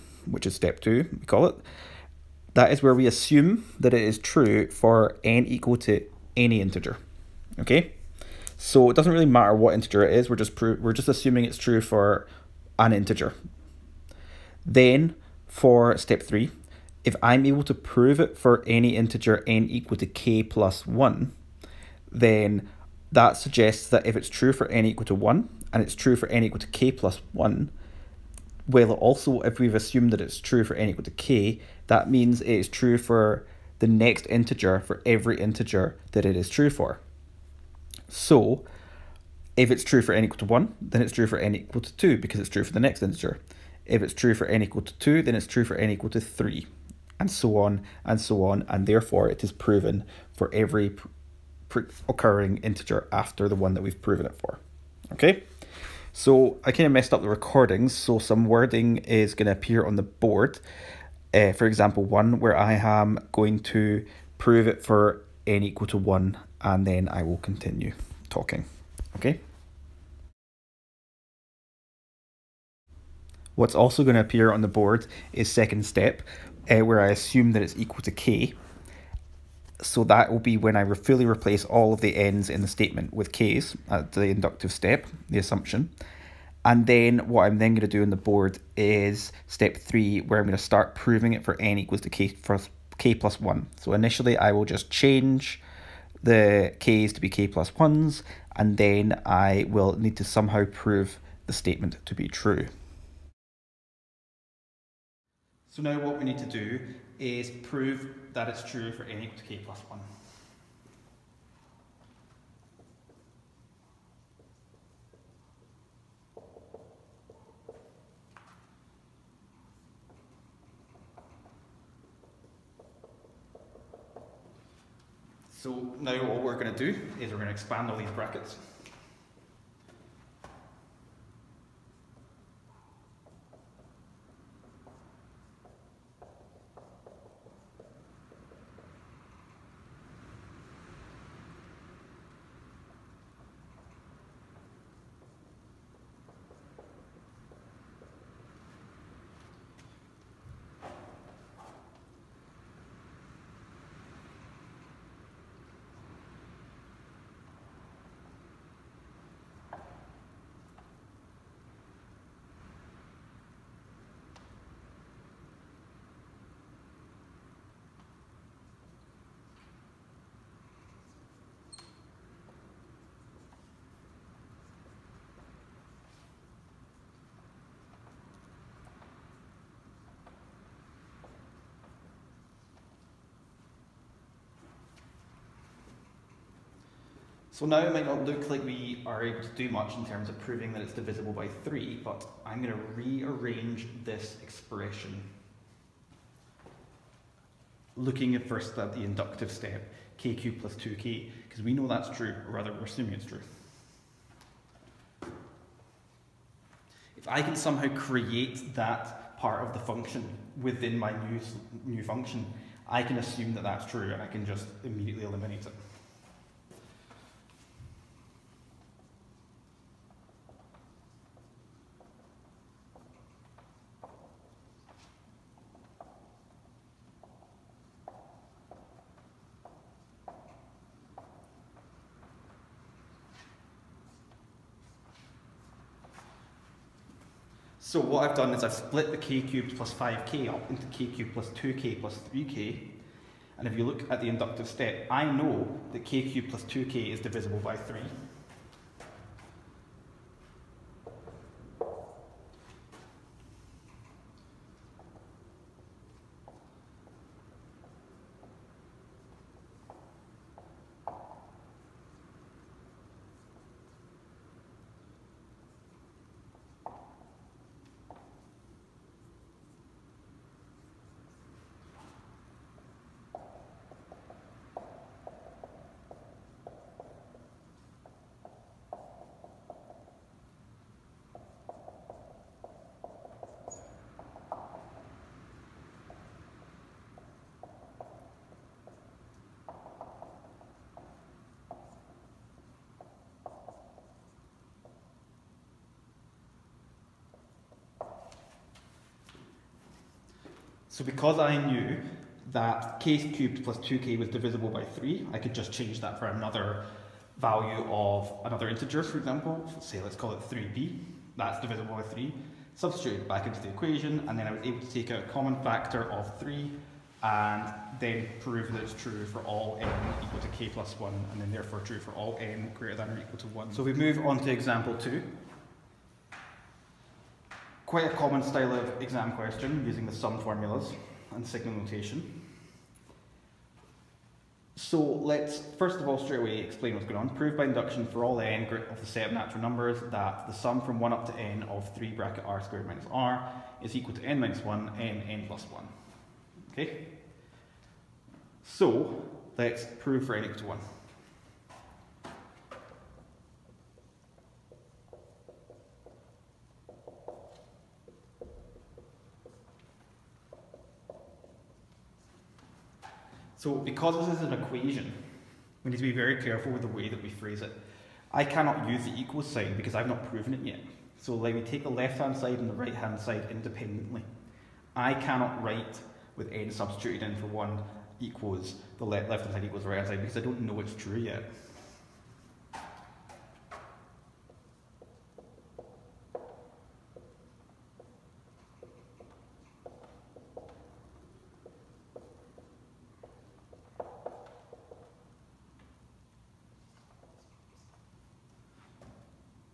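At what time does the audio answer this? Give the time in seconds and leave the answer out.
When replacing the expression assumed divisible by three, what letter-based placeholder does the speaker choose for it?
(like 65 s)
310 s.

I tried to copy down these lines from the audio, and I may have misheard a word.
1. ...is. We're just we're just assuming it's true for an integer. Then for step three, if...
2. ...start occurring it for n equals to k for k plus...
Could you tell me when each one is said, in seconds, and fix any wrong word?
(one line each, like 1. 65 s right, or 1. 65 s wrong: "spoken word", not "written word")
1. 10 s right
2. 90 s wrong: "proving", not "occurring".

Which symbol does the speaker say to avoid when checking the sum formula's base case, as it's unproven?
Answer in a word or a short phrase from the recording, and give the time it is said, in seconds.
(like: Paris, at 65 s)
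equal sign, at 369 s.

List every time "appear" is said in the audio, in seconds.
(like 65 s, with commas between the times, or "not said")
59 s, 74 s.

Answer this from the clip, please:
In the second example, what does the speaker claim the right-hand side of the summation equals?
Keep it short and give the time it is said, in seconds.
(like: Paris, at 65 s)
n minus 1 n n plus 1, at 344 s.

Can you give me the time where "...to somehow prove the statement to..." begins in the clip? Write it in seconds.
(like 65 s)
100 s.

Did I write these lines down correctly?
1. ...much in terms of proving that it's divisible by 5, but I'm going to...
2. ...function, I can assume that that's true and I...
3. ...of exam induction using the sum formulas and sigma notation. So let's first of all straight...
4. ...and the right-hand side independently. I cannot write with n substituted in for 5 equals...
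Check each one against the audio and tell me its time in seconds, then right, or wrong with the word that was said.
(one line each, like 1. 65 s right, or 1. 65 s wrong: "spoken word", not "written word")
1. 189 s wrong: "3", not "5"
2. 212 s right
3. 328 s wrong: "question", not "induction"
4. 372 s wrong: "1", not "5".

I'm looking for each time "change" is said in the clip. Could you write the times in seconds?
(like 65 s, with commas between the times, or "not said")
94 s, 305 s.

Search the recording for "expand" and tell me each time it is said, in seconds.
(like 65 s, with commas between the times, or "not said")
127 s.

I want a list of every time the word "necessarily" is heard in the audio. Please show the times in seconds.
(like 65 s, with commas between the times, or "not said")
not said.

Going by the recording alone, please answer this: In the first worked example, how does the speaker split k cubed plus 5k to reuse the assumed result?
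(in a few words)
k cubed plus 2k plus 3k.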